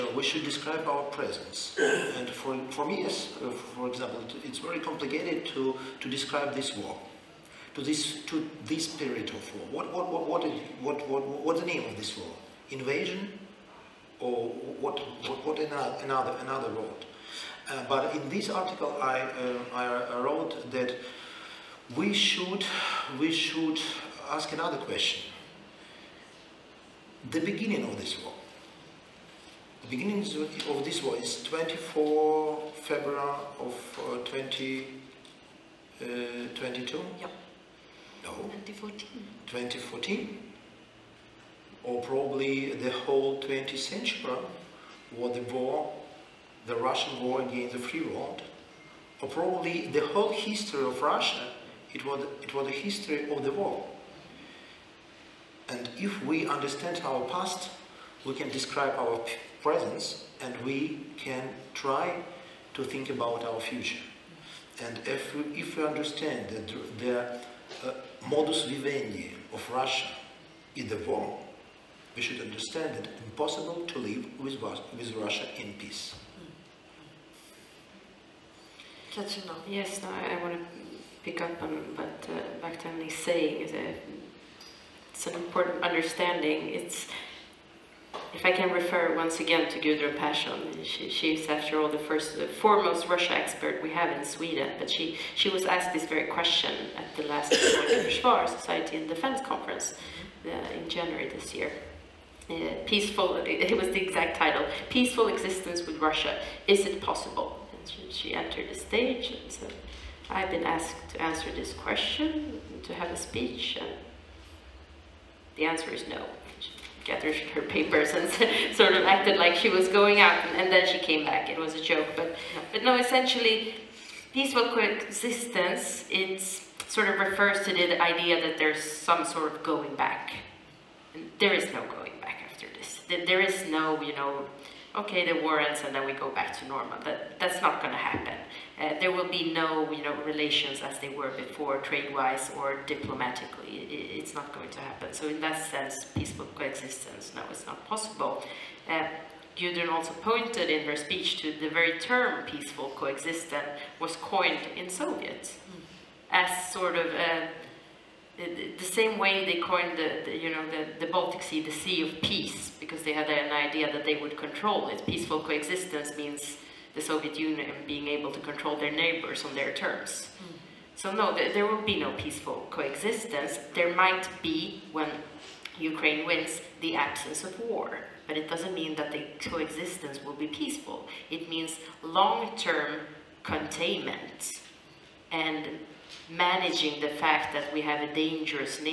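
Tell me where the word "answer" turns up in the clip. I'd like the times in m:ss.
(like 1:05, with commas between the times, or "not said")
1:51, 1:55.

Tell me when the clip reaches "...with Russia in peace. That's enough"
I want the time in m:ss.
1:14.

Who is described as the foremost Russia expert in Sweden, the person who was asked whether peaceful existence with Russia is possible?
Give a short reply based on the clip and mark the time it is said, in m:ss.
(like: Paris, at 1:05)
Gudrun Persson, at 1:29.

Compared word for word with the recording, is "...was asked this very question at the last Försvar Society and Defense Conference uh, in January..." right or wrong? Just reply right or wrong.
right.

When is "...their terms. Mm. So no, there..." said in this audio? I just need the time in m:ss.
2:49.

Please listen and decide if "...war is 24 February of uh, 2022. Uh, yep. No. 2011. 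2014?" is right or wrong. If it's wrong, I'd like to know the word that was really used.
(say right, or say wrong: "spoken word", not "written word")
wrong: "2014", not "2011".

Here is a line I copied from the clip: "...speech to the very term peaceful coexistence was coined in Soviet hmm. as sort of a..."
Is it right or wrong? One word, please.
right.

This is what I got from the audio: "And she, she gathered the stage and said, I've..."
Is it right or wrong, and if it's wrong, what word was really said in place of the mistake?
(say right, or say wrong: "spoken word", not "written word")
wrong: "entered", not "gathered".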